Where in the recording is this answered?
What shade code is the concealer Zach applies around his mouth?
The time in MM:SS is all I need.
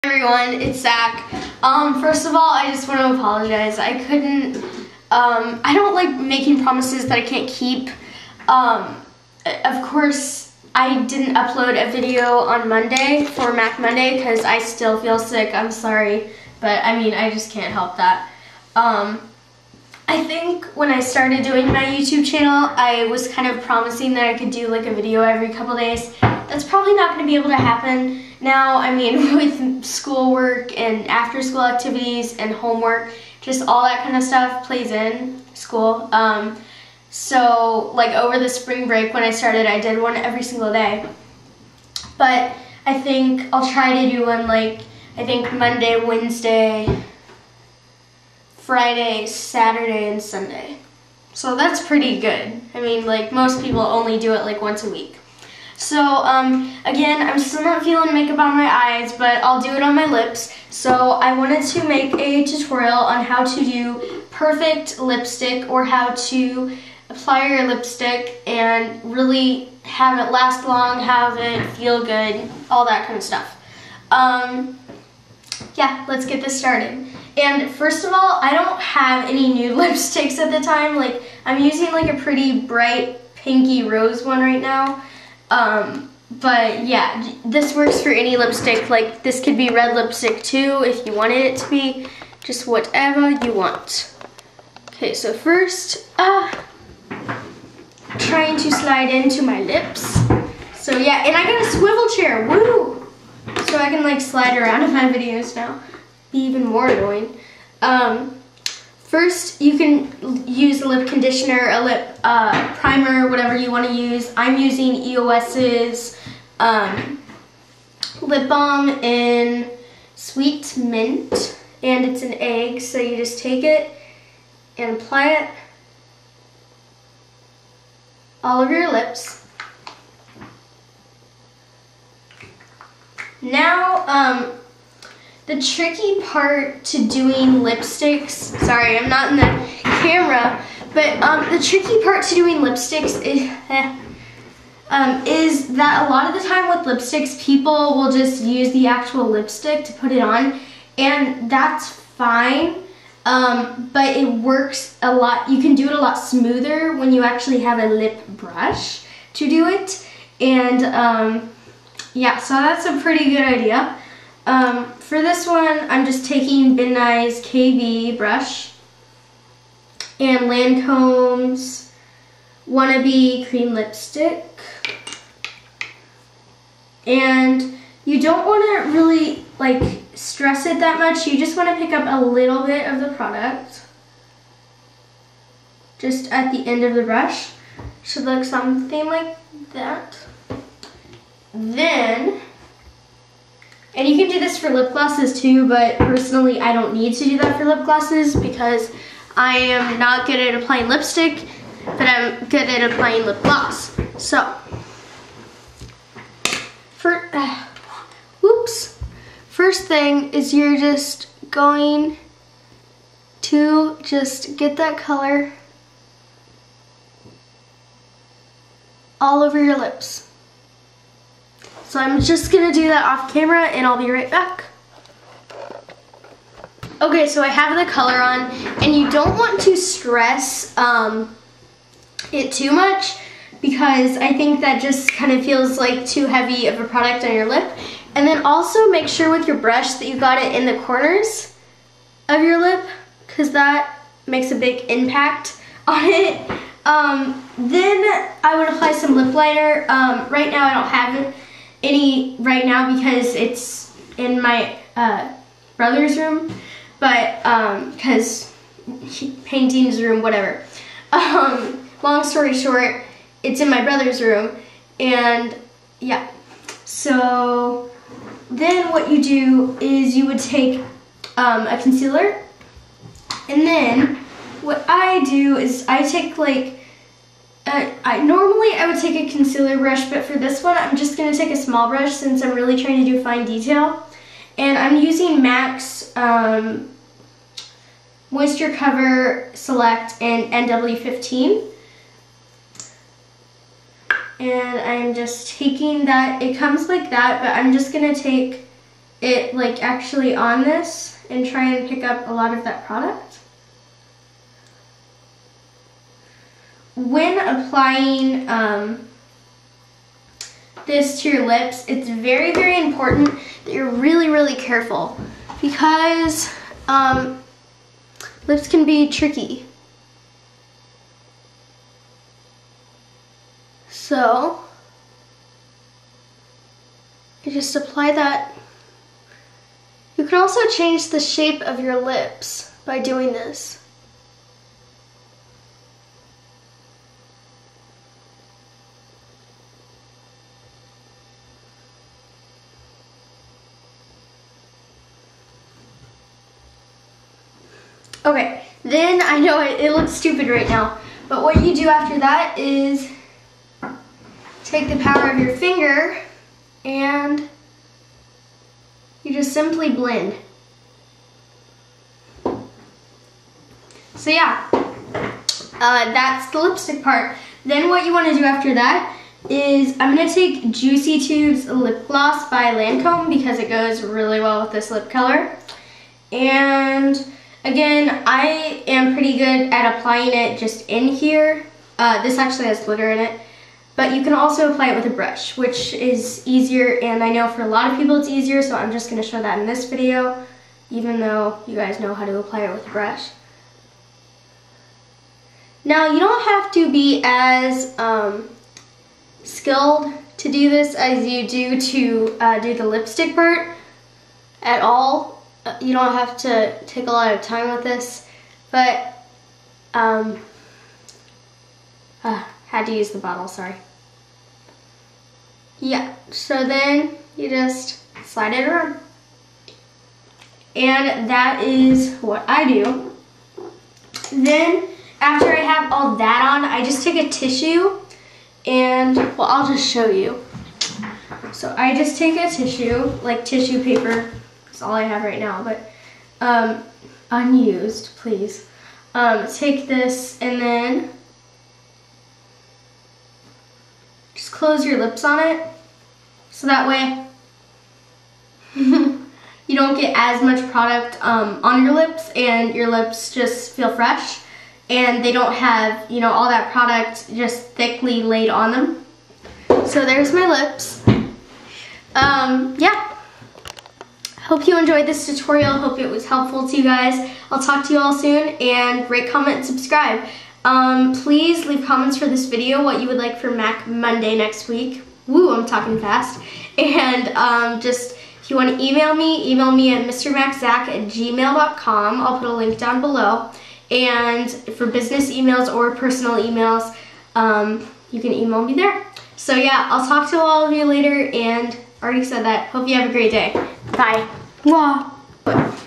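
04:50.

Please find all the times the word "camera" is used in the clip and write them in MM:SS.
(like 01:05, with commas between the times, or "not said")
02:19, 03:43.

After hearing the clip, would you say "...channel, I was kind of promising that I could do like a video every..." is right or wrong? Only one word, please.
right.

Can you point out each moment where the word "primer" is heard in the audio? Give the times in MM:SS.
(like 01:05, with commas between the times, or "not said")
01:52.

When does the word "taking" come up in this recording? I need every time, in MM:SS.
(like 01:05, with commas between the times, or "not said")
02:46, 04:55.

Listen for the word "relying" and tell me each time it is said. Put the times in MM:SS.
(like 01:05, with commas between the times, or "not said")
not said.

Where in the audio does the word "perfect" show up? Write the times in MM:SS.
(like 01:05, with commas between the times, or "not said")
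01:04.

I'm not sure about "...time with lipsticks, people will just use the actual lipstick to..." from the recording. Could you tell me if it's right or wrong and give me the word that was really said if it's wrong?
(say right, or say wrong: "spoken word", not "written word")
right.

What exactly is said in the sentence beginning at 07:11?
So I just take a tissue, like tissue paper, all I have right now, but um, unused, please.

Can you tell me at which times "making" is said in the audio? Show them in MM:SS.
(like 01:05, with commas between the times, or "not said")
00:06.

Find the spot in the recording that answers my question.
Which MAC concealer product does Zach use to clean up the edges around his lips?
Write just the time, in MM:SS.
04:48.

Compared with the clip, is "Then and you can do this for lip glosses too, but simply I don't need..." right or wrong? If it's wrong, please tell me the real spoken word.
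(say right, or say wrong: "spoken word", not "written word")
wrong: "personally", not "simply".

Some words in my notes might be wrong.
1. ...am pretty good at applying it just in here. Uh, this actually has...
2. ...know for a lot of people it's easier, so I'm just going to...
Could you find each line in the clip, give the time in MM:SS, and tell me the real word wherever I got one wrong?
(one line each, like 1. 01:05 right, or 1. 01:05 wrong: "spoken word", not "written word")
1. 06:18 right
2. 06:27 right.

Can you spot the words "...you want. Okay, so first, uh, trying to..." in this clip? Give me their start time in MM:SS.
01:33.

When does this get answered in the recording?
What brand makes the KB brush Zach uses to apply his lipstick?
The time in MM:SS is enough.
02:46.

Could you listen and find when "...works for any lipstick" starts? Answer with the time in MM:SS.
01:27.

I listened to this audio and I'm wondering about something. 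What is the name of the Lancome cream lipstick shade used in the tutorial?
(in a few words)
Wannabe.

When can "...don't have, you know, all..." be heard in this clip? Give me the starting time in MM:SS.
07:35.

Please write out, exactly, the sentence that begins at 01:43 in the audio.
So I can like slide around in my videos now.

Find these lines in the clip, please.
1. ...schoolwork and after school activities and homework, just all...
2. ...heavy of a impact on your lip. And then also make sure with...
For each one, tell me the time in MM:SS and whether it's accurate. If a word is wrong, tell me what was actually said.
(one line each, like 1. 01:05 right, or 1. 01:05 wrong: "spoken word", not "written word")
1. 00:29 right
2. 03:56 wrong: "product", not "impact".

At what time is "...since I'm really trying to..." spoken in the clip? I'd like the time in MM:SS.
04:42.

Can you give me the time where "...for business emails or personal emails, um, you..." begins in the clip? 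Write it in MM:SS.
08:04.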